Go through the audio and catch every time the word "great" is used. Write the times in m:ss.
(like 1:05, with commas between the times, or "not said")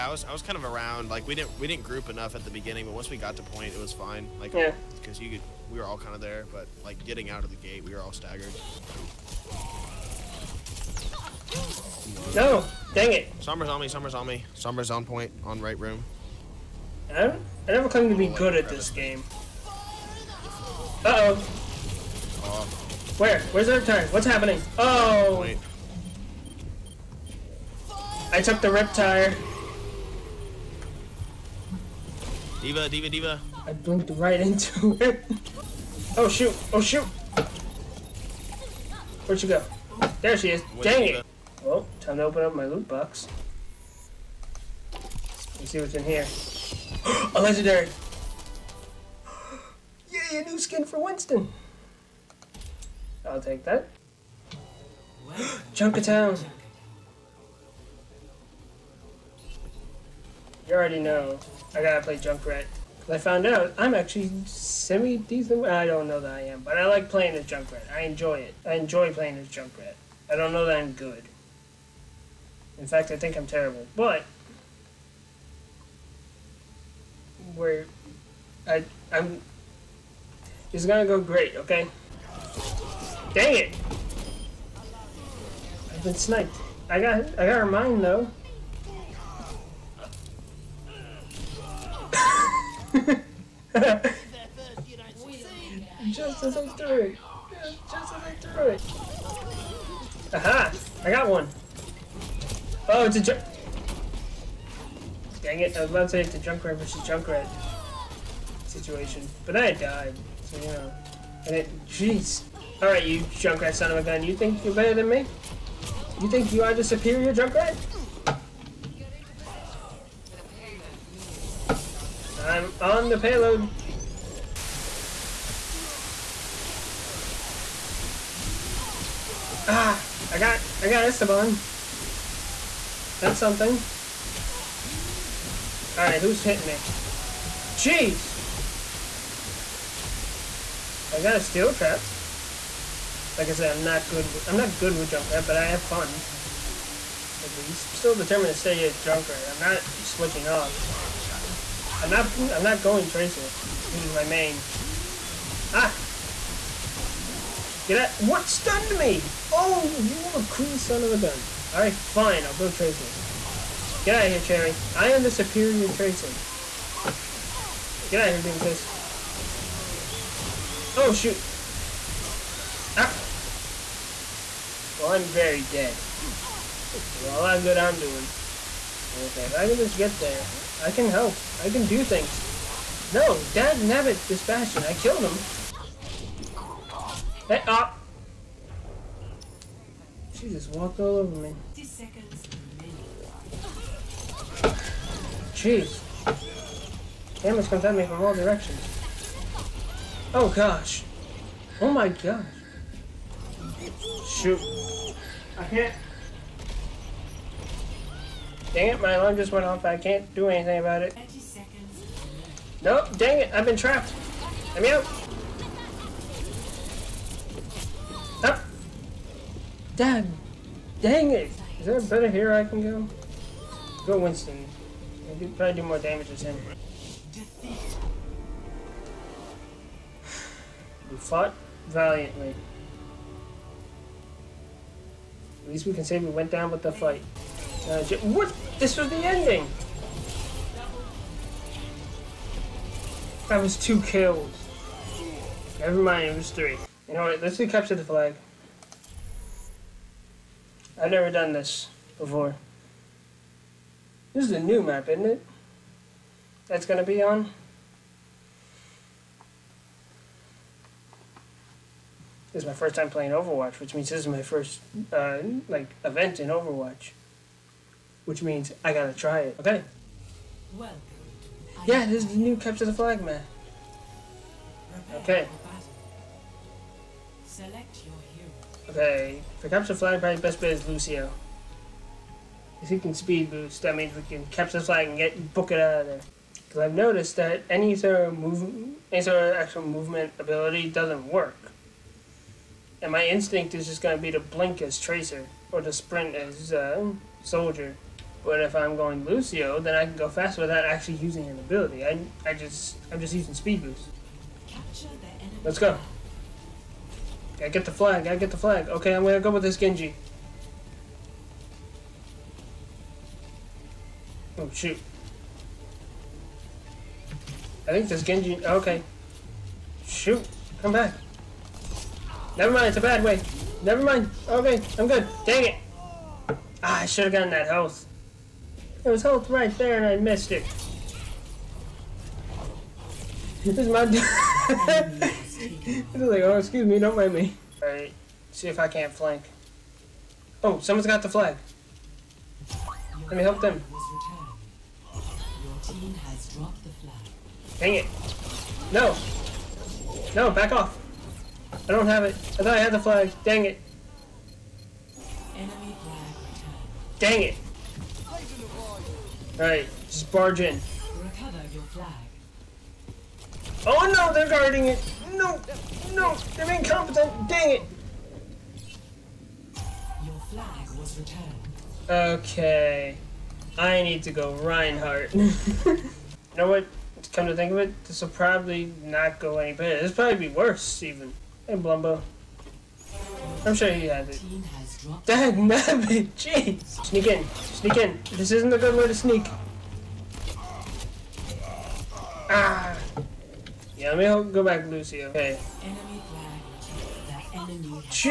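1:21.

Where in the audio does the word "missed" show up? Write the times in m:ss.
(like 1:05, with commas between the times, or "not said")
5:30.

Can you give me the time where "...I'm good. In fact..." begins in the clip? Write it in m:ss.
1:10.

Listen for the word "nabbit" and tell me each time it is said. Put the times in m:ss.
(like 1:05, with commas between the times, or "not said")
3:03, 6:25.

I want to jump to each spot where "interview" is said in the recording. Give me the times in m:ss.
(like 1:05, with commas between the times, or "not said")
not said.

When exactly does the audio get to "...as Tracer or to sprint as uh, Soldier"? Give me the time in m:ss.
4:54.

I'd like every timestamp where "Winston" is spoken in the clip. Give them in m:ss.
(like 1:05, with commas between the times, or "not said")
0:50, 3:44.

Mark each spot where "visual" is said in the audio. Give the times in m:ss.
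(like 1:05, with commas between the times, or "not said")
not said.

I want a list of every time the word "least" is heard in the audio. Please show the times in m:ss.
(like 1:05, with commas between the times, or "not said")
2:27, 3:55.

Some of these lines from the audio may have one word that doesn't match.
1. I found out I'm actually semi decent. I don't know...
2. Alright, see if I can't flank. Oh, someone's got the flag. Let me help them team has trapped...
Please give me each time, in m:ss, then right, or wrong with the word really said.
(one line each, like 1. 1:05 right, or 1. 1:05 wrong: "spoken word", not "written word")
1. 1:03 right
2. 5:37 wrong: "dropped", not "trapped".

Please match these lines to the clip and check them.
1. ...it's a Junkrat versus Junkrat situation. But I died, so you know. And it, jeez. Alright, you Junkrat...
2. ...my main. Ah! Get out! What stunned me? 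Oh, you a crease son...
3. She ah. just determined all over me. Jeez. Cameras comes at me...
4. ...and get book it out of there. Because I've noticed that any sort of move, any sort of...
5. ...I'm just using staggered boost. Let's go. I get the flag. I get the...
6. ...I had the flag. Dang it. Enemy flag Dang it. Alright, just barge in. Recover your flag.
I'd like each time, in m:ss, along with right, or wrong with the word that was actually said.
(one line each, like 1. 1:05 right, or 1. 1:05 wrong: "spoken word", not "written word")
1. 1:46 right
2. 2:34 right
3. 3:10 wrong: "walked", not "determined"
4. 4:45 right
5. 5:03 wrong: "speed", not "staggered"
6. 5:52 right.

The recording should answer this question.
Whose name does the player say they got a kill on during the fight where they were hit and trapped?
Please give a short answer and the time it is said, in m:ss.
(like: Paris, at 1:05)
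Esteban, at 2:11.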